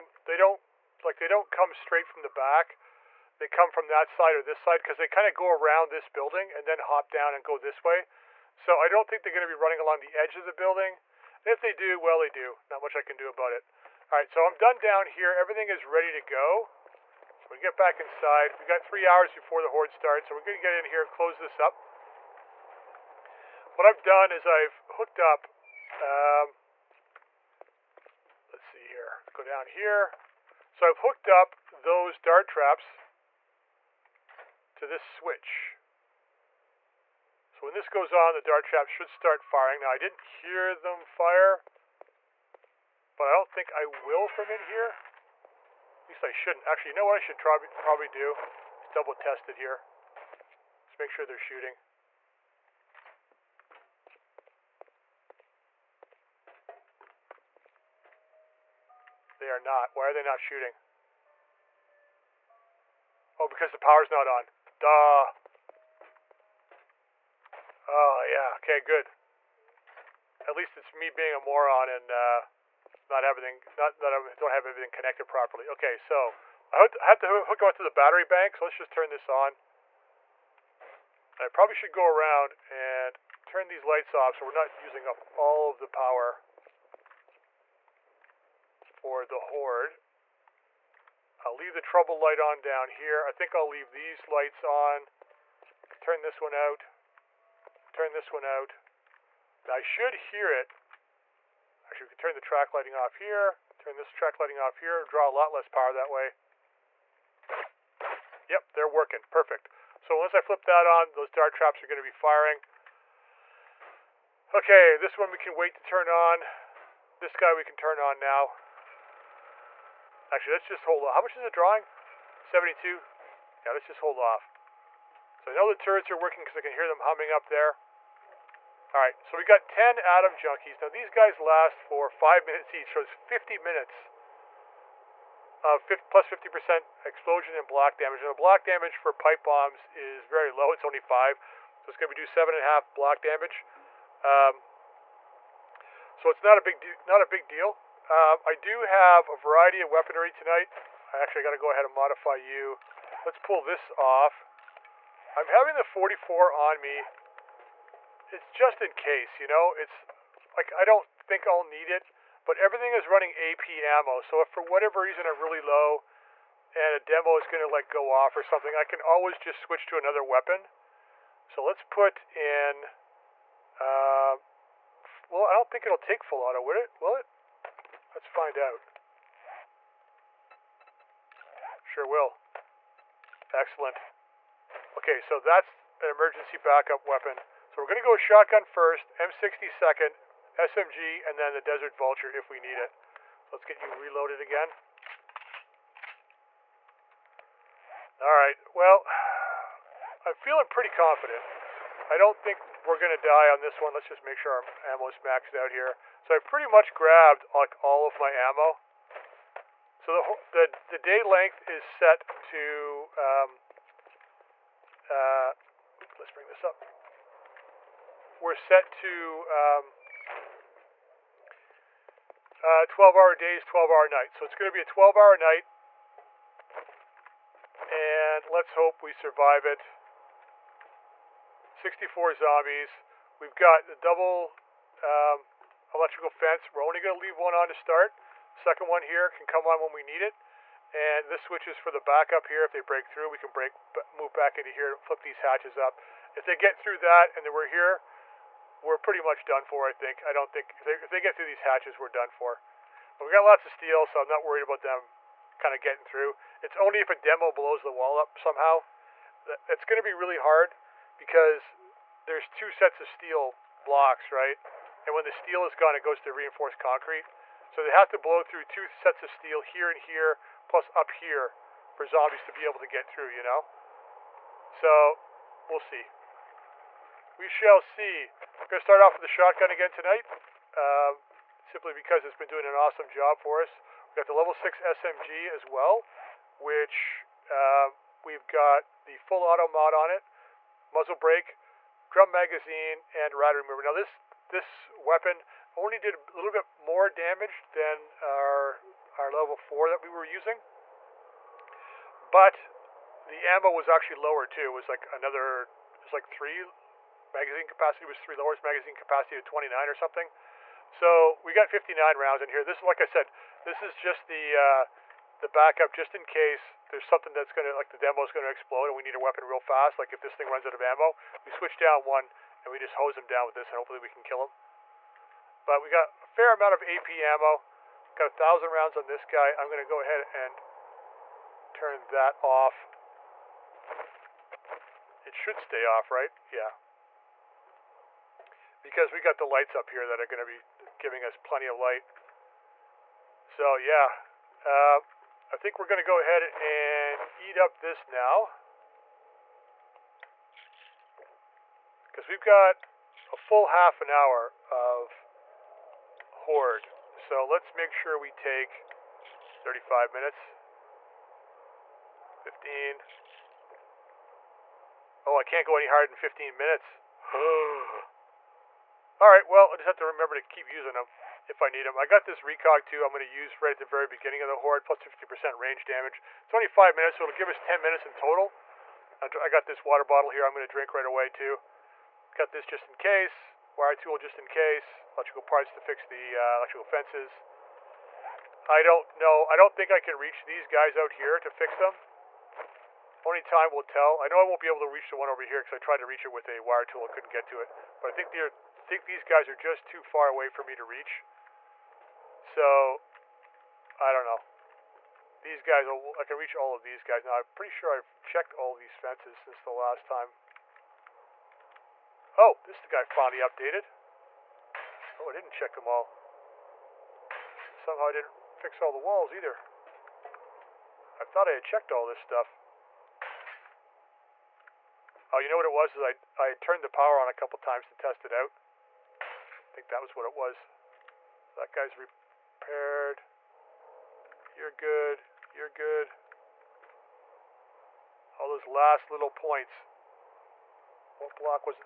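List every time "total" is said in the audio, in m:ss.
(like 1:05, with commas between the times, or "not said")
6:18.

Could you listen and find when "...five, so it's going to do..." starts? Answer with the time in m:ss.
2:21.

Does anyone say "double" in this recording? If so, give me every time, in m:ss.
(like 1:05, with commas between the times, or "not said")
0:48, 3:53.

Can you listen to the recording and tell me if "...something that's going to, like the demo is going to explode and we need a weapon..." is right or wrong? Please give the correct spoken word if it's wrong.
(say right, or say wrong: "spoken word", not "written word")
right.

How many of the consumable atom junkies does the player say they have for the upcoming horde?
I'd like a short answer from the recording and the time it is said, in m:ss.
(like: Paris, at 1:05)
10, at 2:09.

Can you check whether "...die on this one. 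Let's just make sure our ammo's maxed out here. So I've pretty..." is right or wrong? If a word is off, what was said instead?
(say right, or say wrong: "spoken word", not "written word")
right.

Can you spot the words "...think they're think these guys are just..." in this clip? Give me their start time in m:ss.
6:38.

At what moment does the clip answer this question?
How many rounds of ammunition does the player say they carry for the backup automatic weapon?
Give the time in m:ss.
5:28.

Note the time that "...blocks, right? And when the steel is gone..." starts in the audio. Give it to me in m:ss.
4:23.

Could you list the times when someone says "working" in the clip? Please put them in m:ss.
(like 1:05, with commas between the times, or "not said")
1:48, 2:06.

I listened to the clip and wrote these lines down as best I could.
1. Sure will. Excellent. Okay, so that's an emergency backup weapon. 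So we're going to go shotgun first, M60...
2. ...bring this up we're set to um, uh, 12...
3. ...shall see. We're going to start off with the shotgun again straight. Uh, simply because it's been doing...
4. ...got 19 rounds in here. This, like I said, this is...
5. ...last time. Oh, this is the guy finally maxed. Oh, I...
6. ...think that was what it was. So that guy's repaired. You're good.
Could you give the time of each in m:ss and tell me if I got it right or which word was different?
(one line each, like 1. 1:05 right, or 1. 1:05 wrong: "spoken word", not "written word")
1. 3:01 right
2. 3:36 right
3. 4:37 wrong: "tonight", not "straight"
4. 5:11 wrong: "59", not "19"
5. 6:49 wrong: "updated", not "maxed"
6. 7:09 right.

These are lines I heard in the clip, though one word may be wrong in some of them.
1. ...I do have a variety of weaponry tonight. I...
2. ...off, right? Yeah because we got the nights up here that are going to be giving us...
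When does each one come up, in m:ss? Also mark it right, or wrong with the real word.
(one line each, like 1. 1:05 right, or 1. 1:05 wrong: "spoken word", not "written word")
1. 2:28 right
2. 5:35 wrong: "lights", not "nights".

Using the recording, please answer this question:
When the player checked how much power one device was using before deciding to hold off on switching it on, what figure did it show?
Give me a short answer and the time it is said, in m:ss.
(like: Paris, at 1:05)
72, at 2:02.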